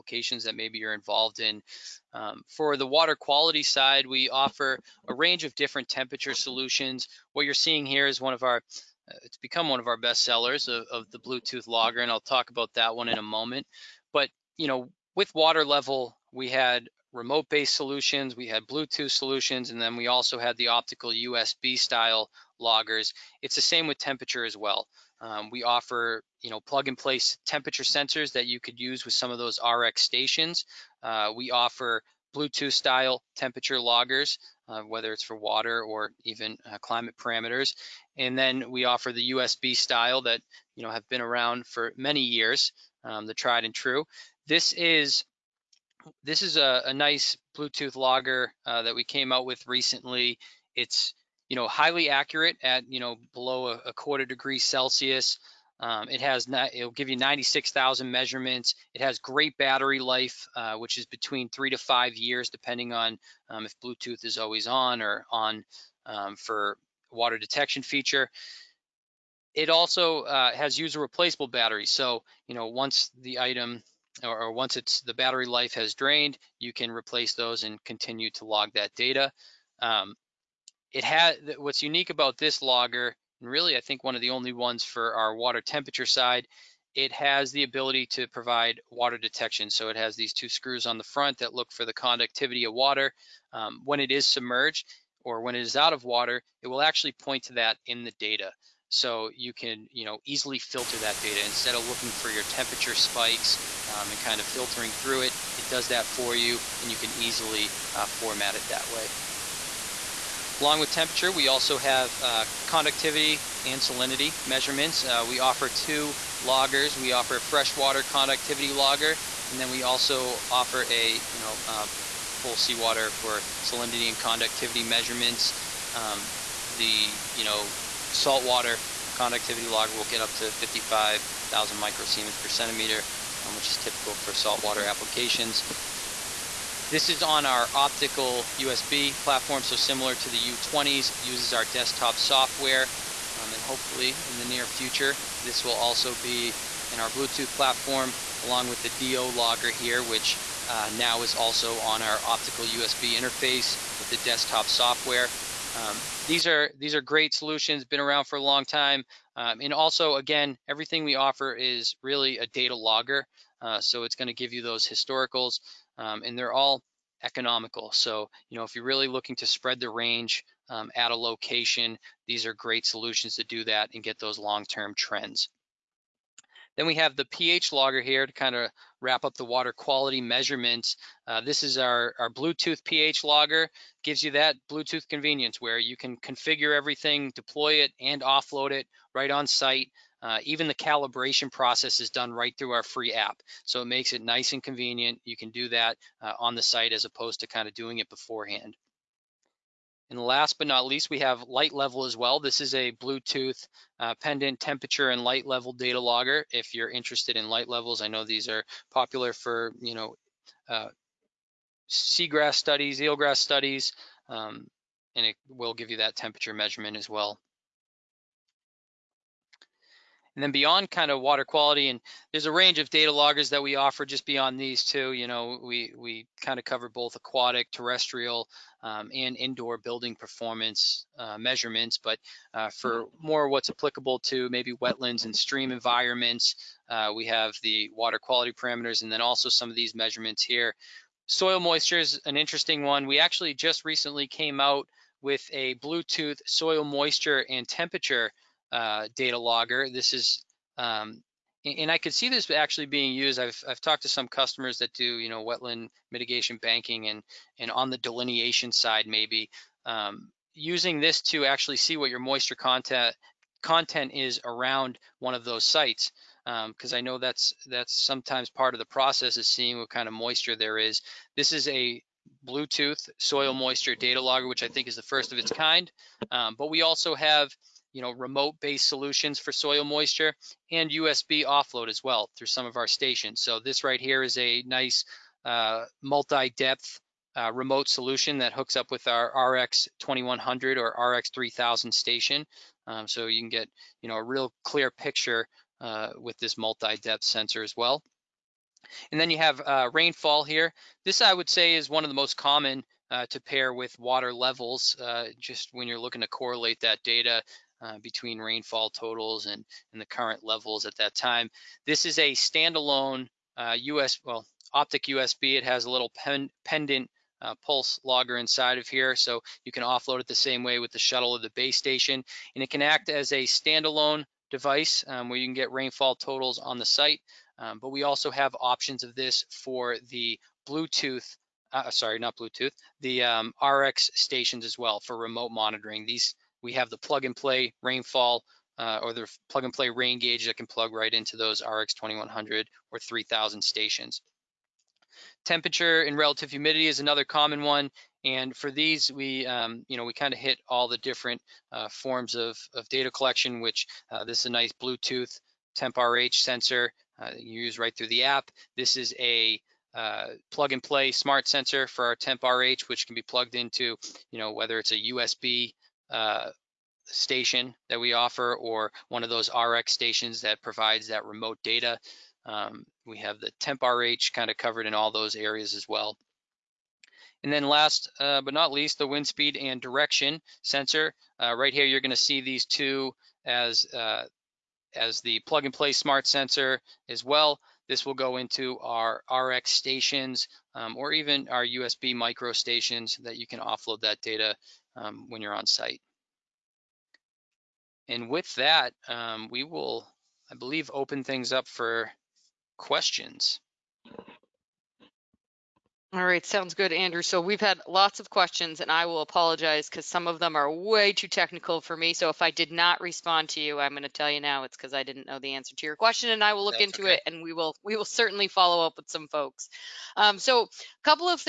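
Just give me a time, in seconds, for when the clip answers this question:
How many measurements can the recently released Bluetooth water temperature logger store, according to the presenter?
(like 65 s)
57 s.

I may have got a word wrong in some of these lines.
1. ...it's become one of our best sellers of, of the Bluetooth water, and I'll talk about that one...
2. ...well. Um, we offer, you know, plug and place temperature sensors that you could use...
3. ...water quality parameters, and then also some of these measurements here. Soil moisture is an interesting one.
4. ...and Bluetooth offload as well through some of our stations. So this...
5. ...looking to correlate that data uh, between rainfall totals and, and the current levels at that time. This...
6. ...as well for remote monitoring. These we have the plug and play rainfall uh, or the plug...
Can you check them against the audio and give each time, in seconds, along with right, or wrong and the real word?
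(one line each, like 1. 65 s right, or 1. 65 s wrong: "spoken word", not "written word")
1. 9 s wrong: "logger", not "water"
2. 24 s right
3. 237 s right
4. 280 s wrong: "USB", not "Bluetooth"
5. 306 s right
6. 334 s right.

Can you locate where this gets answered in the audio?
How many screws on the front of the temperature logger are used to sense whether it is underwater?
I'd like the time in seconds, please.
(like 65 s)
90 s.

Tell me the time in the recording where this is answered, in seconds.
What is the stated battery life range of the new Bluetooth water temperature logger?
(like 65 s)
61 s.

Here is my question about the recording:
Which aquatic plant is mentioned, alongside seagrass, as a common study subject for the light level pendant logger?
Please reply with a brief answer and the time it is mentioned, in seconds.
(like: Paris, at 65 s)
Eelgrass, at 213 s.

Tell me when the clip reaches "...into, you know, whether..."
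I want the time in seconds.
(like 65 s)
363 s.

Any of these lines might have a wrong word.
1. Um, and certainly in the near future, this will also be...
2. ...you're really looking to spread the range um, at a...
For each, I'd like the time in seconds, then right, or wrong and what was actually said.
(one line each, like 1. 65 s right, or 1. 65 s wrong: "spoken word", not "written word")
1. 143 s wrong: "hopefully", not "certainly"
2. 168 s right.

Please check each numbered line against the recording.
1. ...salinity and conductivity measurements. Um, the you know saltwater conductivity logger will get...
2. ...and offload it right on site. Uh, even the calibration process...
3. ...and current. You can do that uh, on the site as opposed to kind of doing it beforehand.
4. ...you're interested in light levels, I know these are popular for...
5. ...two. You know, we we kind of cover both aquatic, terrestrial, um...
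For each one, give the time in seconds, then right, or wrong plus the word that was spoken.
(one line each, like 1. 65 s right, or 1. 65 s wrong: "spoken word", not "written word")
1. 123 s right
2. 188 s right
3. 194 s wrong: "convenient", not "current"
4. 206 s right
5. 224 s right.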